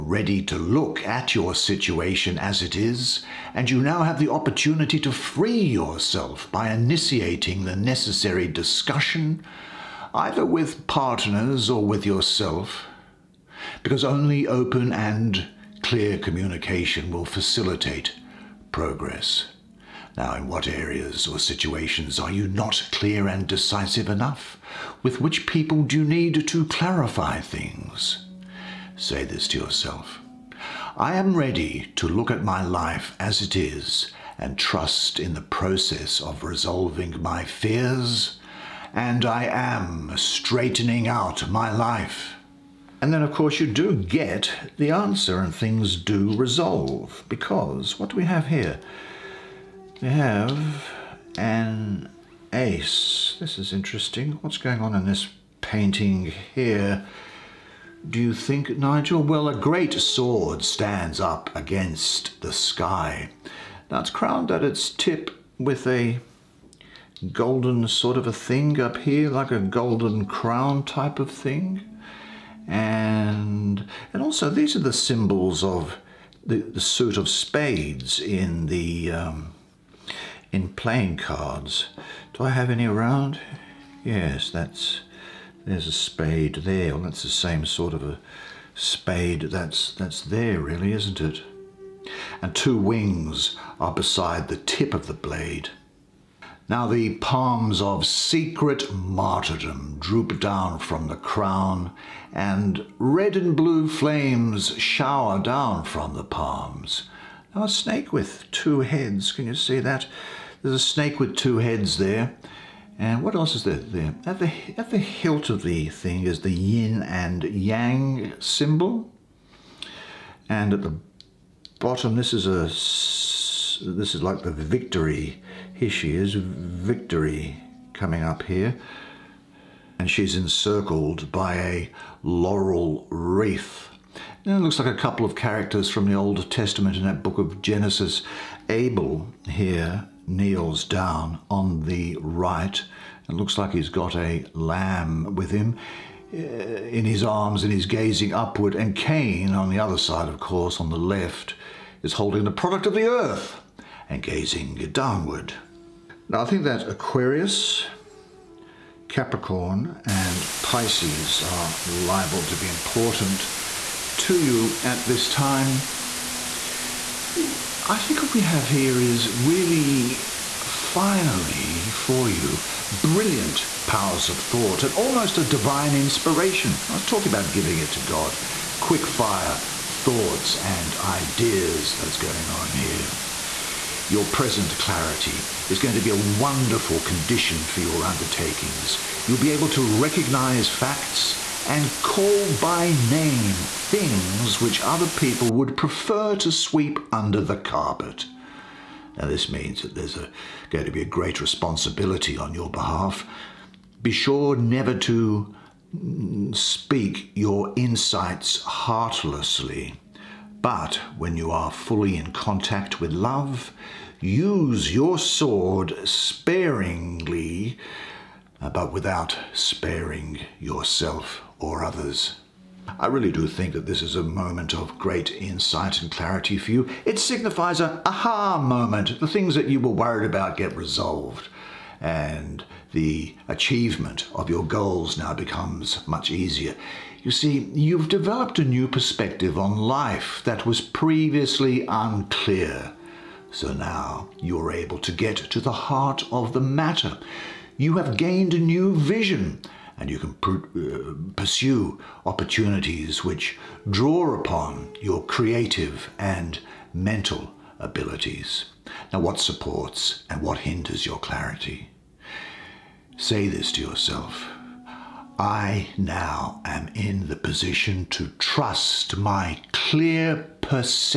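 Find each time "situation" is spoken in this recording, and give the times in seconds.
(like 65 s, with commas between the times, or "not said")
1 s, 21 s.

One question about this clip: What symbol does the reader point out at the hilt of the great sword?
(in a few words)
yin and yang.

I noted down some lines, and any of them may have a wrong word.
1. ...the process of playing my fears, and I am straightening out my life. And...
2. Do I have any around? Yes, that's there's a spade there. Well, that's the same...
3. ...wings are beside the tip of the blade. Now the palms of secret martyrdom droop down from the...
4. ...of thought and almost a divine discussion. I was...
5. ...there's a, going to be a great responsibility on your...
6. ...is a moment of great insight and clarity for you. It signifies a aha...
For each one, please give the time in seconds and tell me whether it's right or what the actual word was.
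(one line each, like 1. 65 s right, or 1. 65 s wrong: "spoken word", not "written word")
1. 35 s wrong: "resolving", not "playing"
2. 82 s right
3. 92 s right
4. 174 s wrong: "inspiration", not "discussion"
5. 199 s right
6. 224 s right.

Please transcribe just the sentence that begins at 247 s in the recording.
You have gained a new vision and you can pr- uh, pursue opportunities which draw upon your creative and mental abilities.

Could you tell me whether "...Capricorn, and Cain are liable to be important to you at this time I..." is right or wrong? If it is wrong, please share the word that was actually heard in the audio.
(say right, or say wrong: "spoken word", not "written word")
wrong: "Pisces", not "Cain".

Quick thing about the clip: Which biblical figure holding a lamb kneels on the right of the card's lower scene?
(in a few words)
Abel.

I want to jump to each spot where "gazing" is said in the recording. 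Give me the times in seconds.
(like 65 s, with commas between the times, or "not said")
147 s, 154 s.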